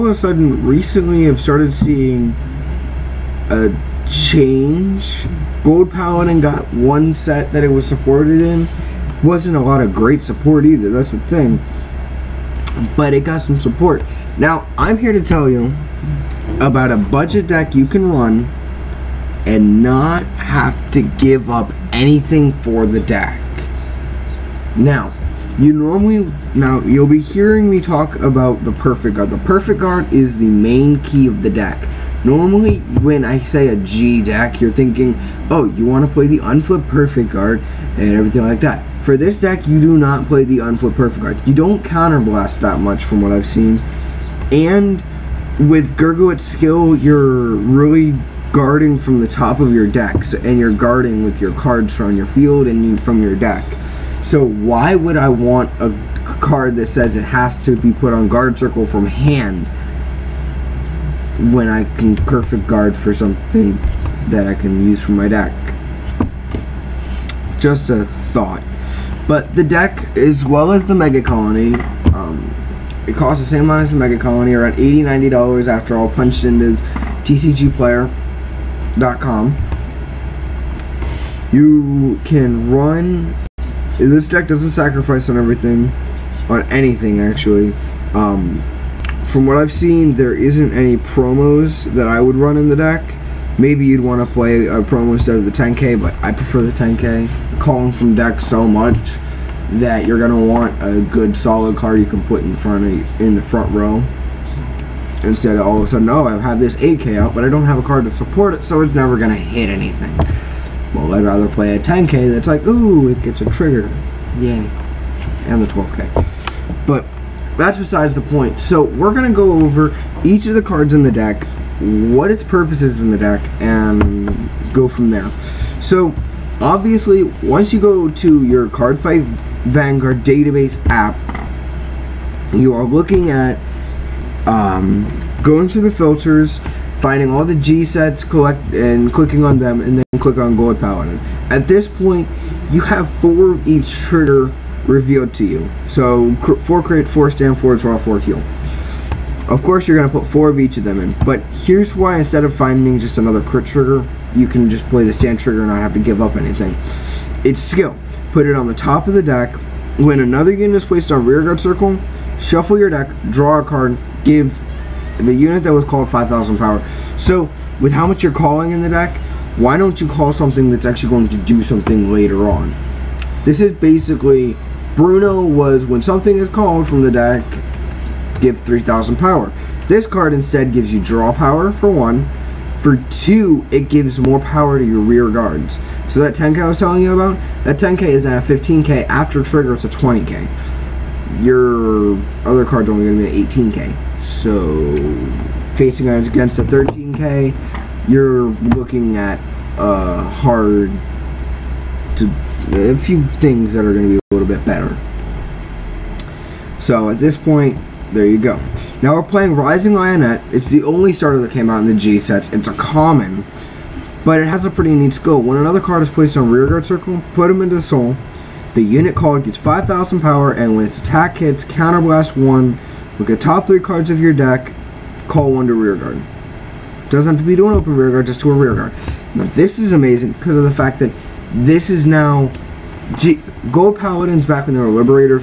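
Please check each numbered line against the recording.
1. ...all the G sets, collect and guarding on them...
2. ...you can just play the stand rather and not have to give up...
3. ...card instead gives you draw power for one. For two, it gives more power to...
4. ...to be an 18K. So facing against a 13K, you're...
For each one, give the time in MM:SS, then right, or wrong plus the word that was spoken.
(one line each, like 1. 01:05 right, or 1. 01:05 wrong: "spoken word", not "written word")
1. 02:17 wrong: "clicking", not "guarding"
2. 02:34 wrong: "trigger", not "rather"
3. 03:00 right
4. 03:13 right.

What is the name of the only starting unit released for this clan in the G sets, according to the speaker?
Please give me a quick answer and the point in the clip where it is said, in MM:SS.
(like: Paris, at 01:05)
Rising Lionet, at 03:29.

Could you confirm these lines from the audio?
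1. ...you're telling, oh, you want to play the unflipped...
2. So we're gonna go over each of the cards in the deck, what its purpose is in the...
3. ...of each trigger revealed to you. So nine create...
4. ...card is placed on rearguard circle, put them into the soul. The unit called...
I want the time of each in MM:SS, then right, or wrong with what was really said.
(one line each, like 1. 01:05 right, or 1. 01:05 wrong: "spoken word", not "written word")
1. 00:34 wrong: "thinking", not "telling"
2. 01:58 right
3. 02:23 wrong: "four", not "nine"
4. 03:35 right.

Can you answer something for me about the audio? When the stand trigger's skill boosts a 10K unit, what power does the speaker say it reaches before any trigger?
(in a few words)
15K.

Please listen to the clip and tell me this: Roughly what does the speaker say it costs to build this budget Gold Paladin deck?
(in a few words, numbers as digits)
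$80-$90.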